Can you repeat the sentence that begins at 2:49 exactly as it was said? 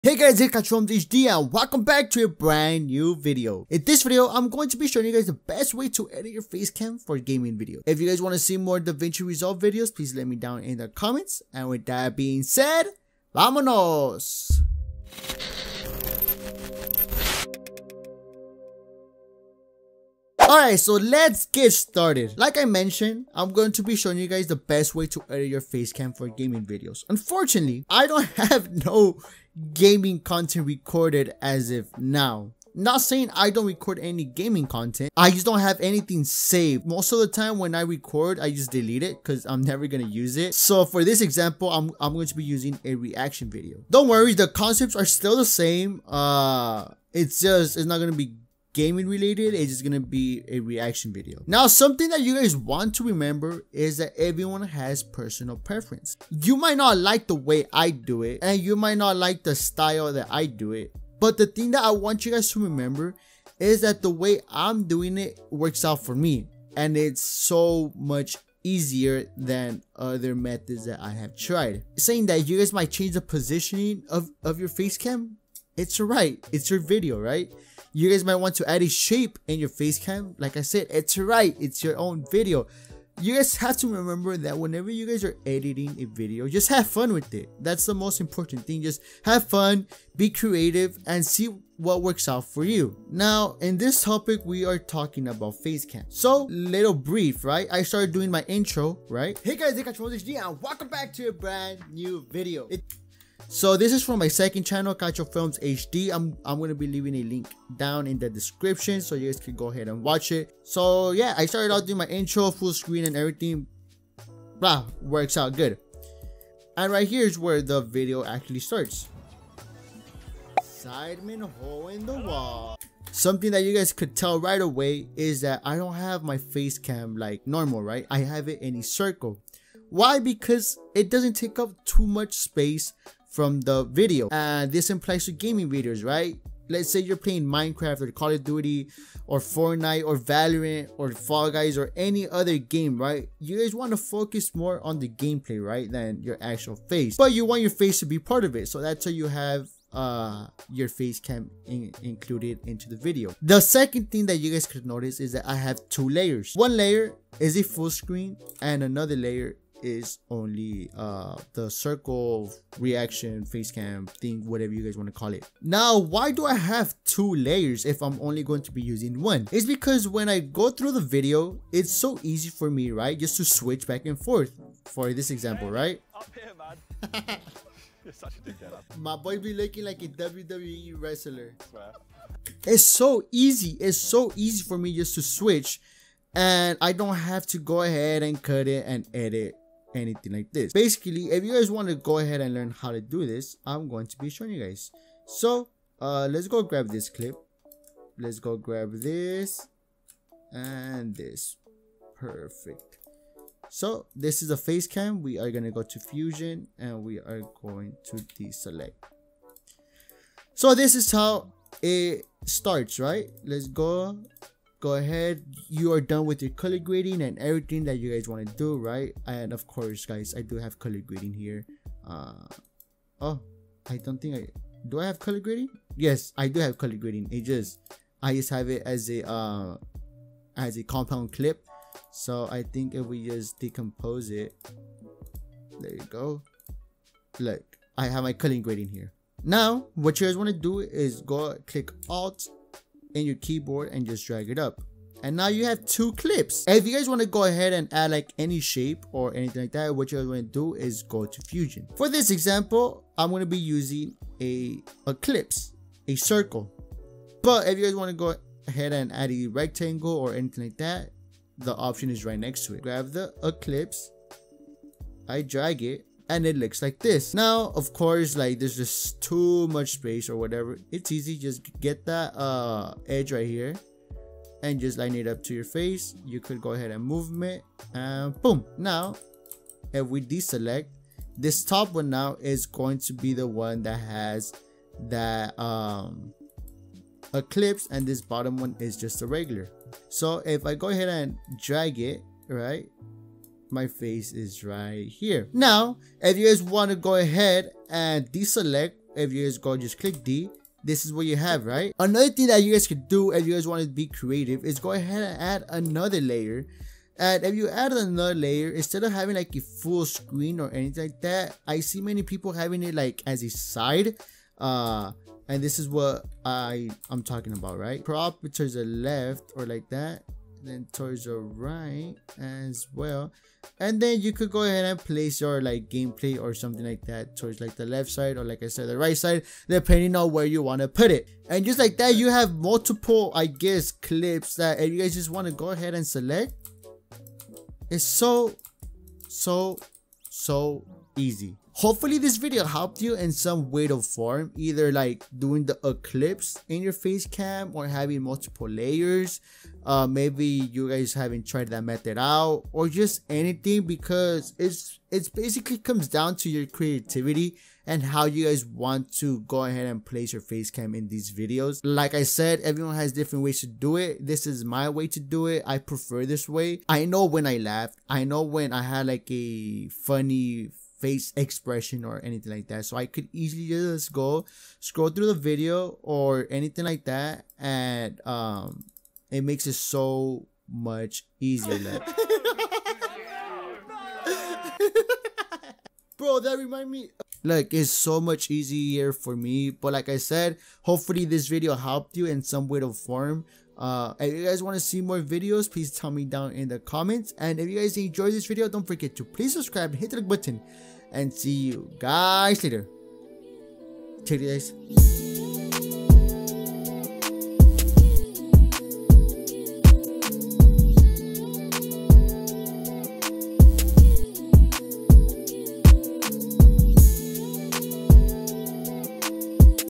It's because when I go through the video, it's so easy for me, right?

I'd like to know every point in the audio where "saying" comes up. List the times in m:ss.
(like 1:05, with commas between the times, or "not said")
0:32, 1:11.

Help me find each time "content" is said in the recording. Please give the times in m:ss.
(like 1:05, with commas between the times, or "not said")
0:30, 0:34.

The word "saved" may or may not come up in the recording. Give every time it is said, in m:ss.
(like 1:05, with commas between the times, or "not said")
0:36.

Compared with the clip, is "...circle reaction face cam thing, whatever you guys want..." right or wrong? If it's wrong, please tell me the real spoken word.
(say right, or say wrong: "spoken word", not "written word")
right.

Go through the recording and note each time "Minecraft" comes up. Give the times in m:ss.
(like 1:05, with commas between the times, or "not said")
2:17.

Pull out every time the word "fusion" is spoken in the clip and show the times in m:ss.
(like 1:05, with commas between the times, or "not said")
3:25, 4:11.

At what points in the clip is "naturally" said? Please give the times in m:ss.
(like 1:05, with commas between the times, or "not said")
not said.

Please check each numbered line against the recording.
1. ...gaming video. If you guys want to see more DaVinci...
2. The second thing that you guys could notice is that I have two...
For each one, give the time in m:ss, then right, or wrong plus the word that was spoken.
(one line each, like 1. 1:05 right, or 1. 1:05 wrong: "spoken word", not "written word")
1. 0:07 right
2. 2:33 right.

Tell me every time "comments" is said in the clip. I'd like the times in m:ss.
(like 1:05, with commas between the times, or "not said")
0:10, 6:36.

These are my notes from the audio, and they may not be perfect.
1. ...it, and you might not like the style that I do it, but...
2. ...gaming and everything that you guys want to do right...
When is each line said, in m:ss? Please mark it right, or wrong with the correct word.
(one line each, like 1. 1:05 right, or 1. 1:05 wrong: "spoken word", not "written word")
1. 0:58 right
2. 3:36 wrong: "grading", not "gaming".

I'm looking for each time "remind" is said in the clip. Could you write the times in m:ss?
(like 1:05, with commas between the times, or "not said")
6:26.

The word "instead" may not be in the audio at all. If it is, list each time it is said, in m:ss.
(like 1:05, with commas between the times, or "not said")
5:08.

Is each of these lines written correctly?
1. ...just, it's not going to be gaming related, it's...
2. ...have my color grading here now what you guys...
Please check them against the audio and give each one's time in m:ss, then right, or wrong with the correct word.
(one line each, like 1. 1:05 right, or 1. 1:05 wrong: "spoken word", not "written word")
1. 0:47 right
2. 3:58 right.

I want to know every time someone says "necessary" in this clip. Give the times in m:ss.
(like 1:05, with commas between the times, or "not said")
not said.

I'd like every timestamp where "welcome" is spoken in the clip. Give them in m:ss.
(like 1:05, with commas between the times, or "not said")
0:01, 1:40.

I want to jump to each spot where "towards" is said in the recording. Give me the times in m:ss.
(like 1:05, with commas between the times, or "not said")
5:20, 5:27.